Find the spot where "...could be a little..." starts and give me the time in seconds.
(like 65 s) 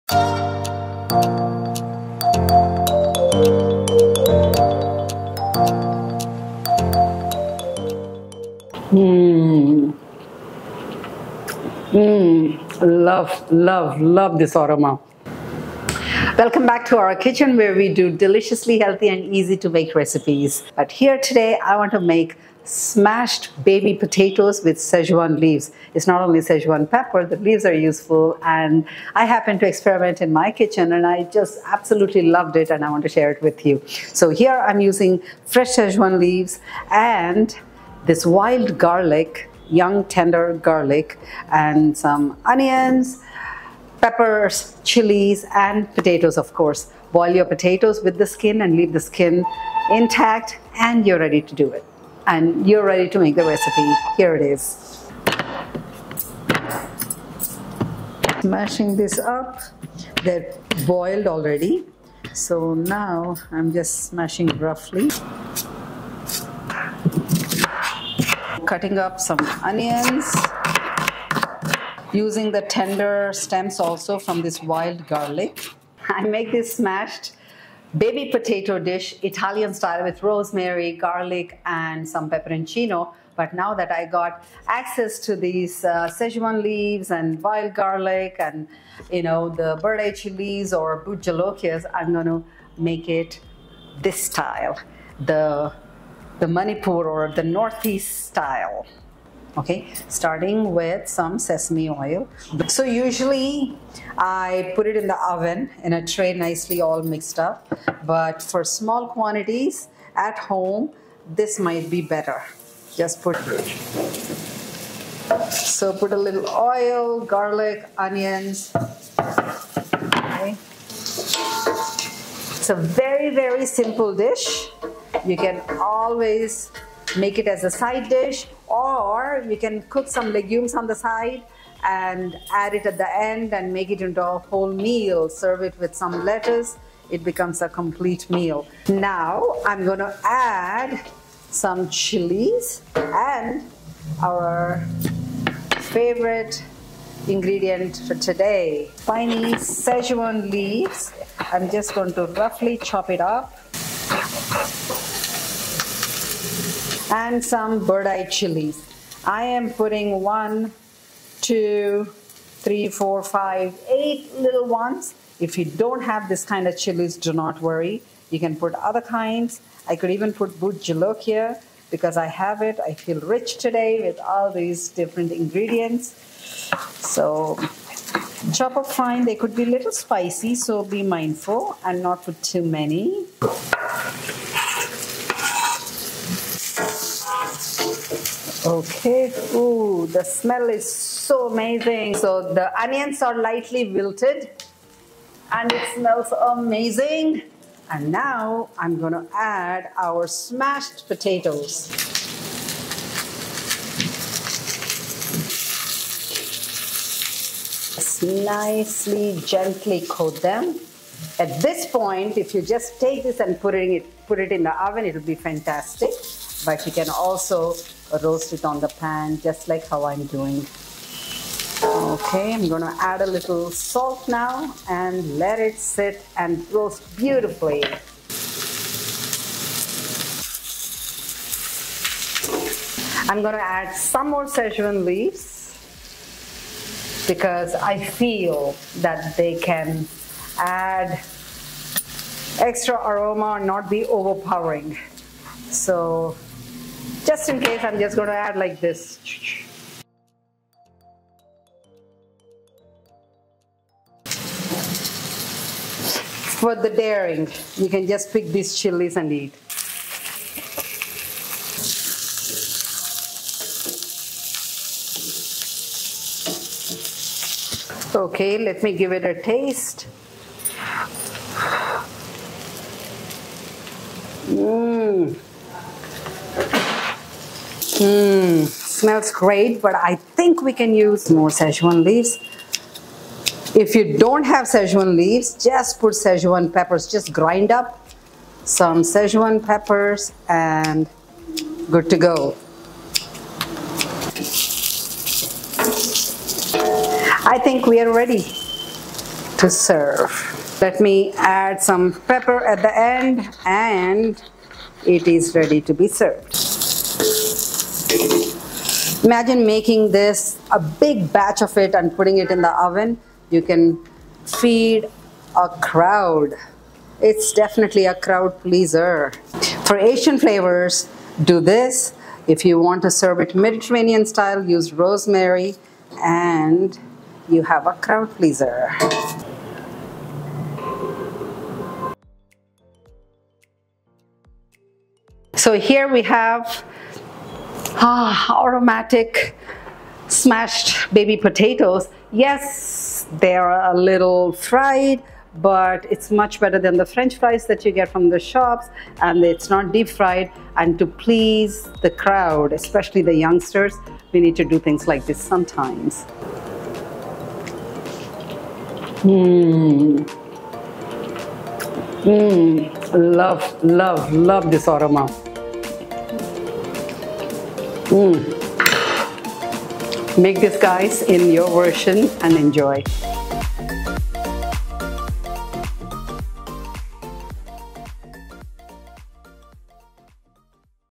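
179 s.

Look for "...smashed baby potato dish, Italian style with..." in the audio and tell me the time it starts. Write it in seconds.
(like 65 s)
76 s.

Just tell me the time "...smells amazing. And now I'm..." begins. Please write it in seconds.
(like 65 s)
195 s.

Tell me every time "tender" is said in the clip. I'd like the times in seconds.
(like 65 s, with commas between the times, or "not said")
40 s, 72 s.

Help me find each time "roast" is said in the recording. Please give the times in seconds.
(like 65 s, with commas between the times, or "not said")
218 s, 226 s.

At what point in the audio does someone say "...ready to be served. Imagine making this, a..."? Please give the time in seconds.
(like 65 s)
305 s.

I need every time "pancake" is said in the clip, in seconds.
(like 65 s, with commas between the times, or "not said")
not said.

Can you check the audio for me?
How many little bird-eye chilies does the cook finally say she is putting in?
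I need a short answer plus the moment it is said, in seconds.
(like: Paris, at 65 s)
8, at 163 s.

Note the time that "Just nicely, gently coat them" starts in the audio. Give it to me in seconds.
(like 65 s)
207 s.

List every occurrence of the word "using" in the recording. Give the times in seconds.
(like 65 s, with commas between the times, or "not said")
34 s, 72 s.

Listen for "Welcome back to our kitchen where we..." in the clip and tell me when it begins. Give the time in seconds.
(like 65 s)
16 s.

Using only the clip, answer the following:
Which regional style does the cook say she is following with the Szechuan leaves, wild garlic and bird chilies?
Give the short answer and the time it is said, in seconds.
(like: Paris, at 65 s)
Manipur, at 96 s.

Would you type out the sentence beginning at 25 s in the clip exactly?
It's not only Szechuan pepper, the leaves are useful.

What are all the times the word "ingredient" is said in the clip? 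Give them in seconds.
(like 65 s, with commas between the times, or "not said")
147 s, 175 s.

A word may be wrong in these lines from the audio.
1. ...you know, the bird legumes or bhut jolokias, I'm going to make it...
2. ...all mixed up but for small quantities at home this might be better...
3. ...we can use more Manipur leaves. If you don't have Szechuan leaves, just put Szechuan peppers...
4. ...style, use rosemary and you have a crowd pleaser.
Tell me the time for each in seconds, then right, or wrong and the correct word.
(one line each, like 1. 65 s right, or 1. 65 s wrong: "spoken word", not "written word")
1. 89 s wrong: "chilies", not "legumes"
2. 106 s right
3. 280 s wrong: "Szechuan", not "Manipur"
4. 324 s right.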